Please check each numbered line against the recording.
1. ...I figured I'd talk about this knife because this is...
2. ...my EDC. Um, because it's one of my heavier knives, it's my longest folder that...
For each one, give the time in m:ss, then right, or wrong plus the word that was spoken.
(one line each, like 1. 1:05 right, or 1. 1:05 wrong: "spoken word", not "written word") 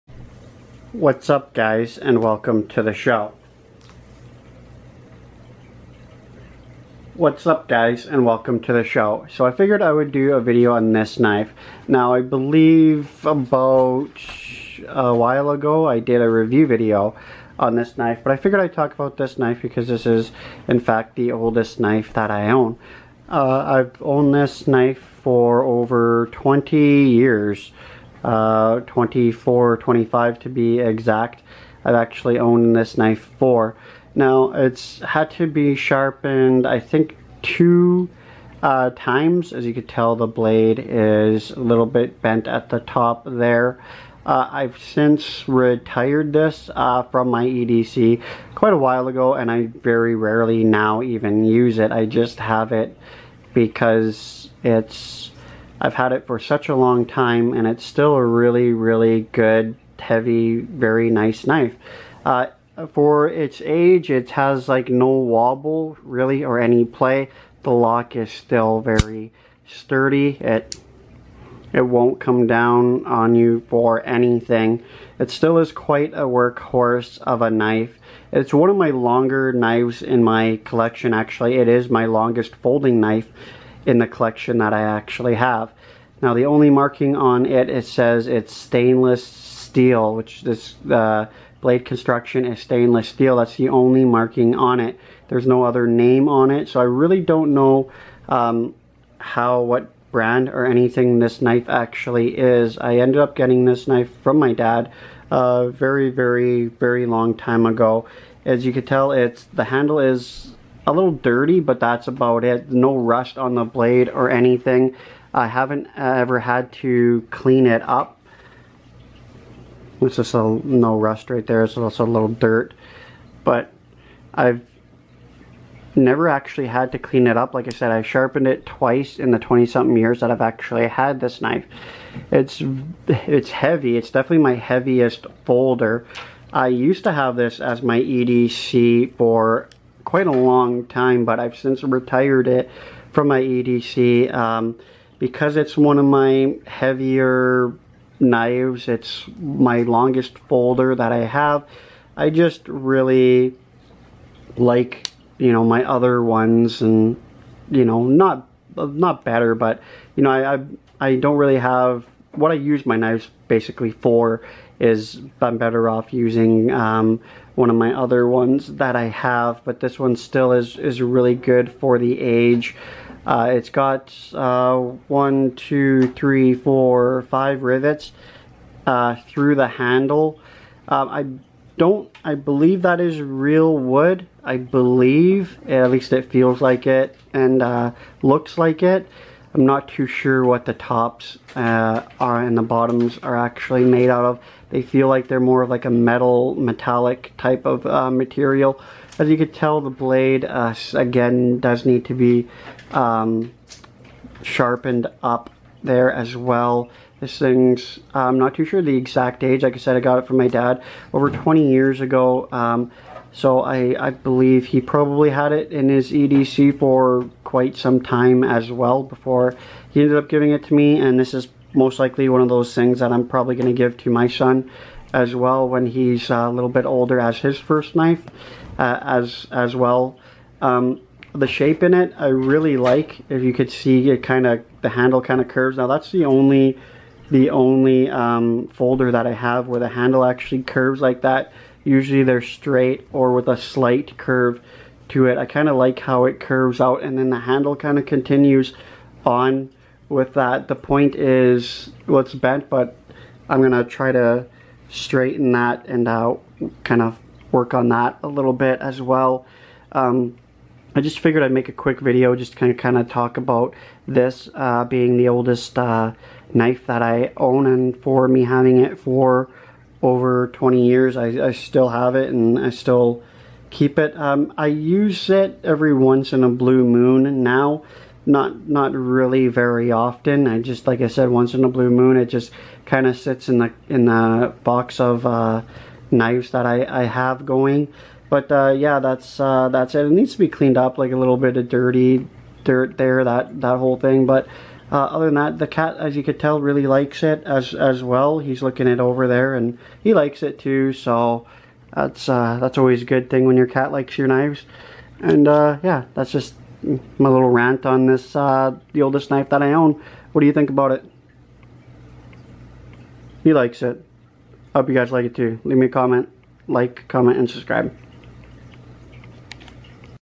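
1. 0:18 right
2. 2:23 right.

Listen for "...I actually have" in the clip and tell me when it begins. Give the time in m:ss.
1:24.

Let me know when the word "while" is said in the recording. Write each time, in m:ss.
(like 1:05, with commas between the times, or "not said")
0:15, 0:48.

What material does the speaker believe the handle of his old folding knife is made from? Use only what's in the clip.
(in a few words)
wood.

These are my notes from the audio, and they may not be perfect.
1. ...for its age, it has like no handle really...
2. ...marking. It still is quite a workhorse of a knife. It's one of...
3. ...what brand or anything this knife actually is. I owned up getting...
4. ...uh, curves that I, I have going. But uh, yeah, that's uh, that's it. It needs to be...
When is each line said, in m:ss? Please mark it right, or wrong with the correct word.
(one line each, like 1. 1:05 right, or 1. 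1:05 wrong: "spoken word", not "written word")
1. 1:02 wrong: "wobble", not "handle"
2. 1:14 wrong: "anything", not "marking"
3. 1:39 wrong: "ended", not "owned"
4. 4:45 wrong: "knives", not "curves".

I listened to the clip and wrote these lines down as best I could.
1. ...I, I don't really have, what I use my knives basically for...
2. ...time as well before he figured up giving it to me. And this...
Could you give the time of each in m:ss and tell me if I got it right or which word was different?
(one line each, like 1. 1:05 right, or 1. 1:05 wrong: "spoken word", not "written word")
1. 2:40 right
2. 3:38 wrong: "ended", not "figured".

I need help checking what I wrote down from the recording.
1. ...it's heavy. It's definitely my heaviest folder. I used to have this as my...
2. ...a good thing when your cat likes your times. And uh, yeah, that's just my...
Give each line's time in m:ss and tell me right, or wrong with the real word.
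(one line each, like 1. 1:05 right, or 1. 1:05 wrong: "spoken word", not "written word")
1. 2:13 right
2. 5:03 wrong: "knives", not "times".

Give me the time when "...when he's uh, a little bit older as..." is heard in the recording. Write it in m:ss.
3:45.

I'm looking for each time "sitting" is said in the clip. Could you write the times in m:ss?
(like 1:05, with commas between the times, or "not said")
not said.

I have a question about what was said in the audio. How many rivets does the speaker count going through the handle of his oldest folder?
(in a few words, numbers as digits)
5.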